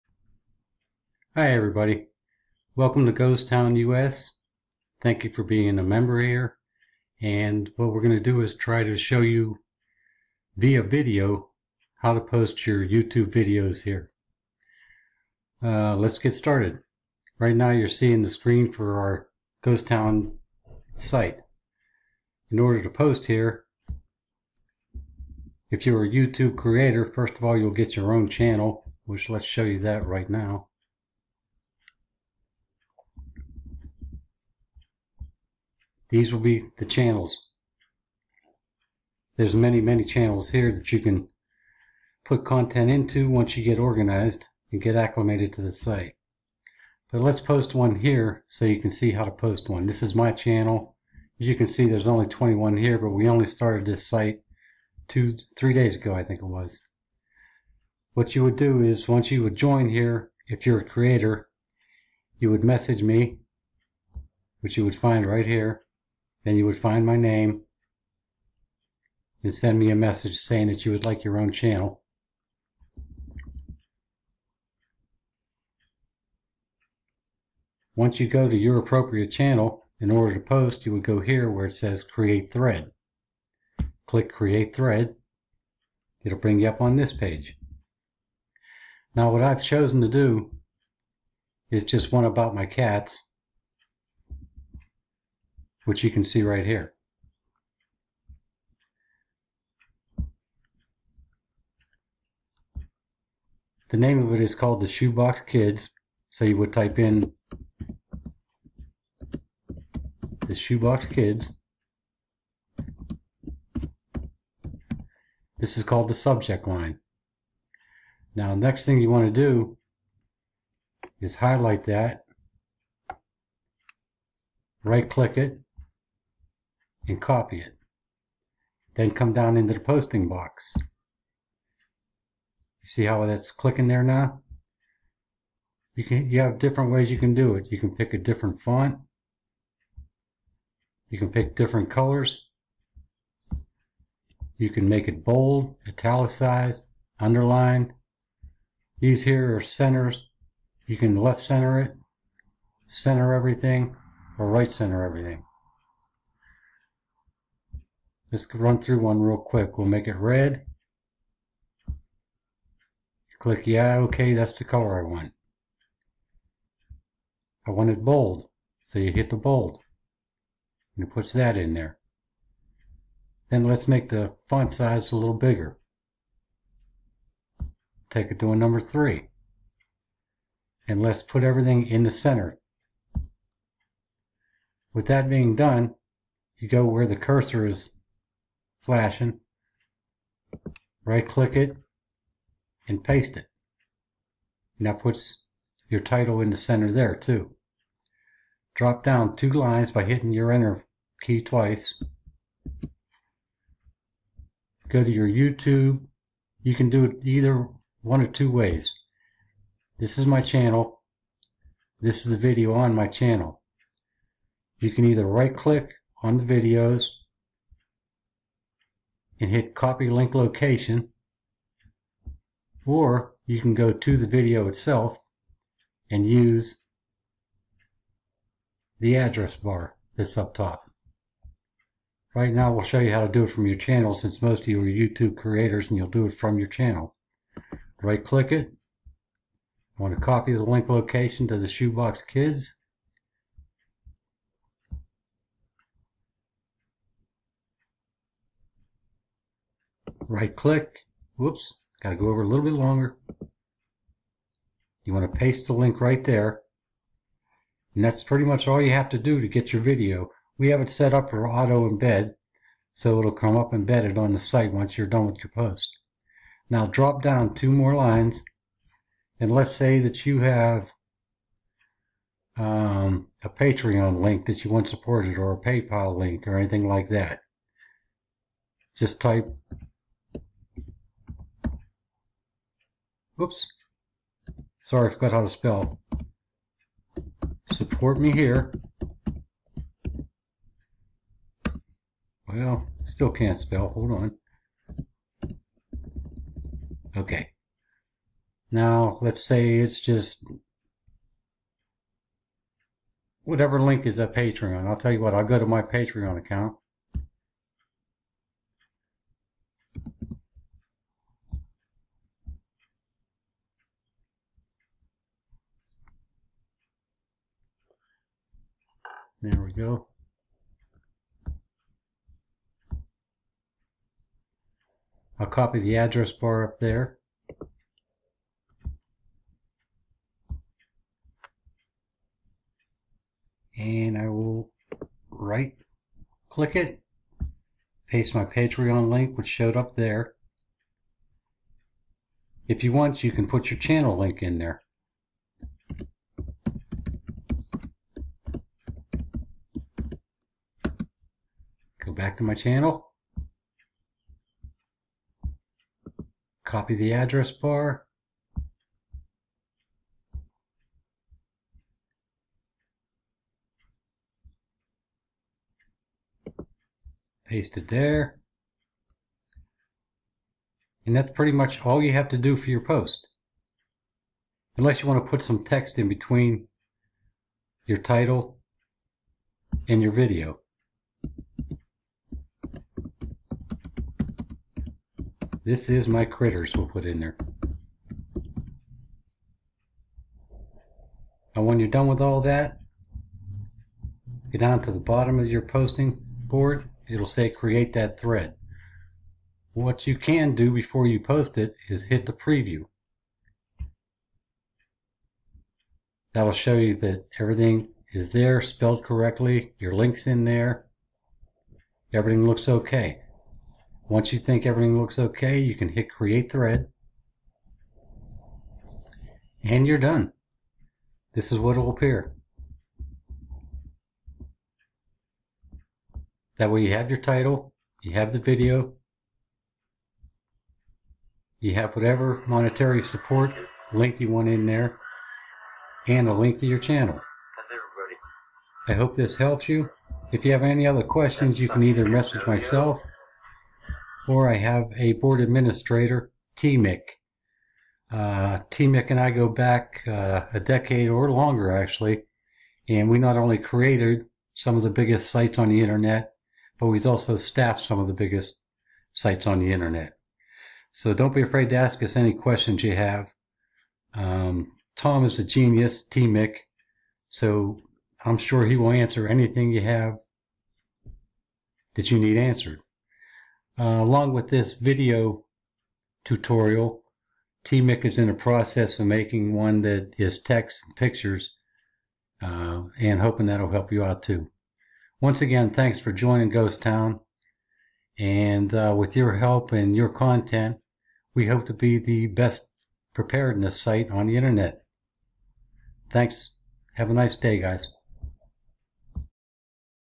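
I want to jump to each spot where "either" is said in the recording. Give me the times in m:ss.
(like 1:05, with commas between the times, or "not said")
3:27, 3:35, 7:21.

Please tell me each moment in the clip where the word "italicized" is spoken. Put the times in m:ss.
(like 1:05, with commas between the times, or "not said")
2:25.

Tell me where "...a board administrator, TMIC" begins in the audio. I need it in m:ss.
7:24.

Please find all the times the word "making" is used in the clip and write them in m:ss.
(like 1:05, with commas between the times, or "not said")
7:59.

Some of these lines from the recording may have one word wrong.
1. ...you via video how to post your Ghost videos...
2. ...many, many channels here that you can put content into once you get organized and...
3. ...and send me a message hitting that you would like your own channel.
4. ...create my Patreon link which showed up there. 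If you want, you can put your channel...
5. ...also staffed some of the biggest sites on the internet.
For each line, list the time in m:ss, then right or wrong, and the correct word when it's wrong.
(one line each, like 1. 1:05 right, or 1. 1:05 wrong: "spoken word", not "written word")
1. 0:09 wrong: "YouTube", not "Ghost"
2. 0:39 right
3. 1:09 wrong: "saying", not "hitting"
4. 5:38 wrong: "paste", not "create"
5. 7:37 right.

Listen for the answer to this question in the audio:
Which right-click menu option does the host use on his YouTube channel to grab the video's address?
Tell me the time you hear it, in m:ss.
3:39.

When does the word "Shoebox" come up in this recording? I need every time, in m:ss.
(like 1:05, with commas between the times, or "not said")
1:44, 1:50, 4:01.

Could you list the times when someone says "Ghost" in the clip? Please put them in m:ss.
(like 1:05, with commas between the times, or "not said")
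0:03, 0:19, 8:06.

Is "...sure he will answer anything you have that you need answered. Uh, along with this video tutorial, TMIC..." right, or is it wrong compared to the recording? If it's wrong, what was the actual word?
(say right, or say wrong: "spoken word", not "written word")
right.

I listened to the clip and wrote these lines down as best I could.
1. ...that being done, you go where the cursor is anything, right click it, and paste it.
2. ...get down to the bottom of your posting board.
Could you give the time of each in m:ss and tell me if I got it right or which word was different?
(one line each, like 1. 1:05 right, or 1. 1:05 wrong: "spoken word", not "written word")
1. 3:05 wrong: "flashing", not "anything"
2. 6:34 right.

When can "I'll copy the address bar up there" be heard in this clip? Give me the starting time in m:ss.
5:25.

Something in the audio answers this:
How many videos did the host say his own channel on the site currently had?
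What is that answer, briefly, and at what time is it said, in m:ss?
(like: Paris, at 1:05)
21, at 0:52.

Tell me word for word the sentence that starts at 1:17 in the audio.
Once you go to your appropriate channel, in order to post, you would go here where it says Create Thread.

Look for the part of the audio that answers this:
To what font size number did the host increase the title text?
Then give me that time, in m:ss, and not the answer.
2:58.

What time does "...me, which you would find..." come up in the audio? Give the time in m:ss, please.
1:03.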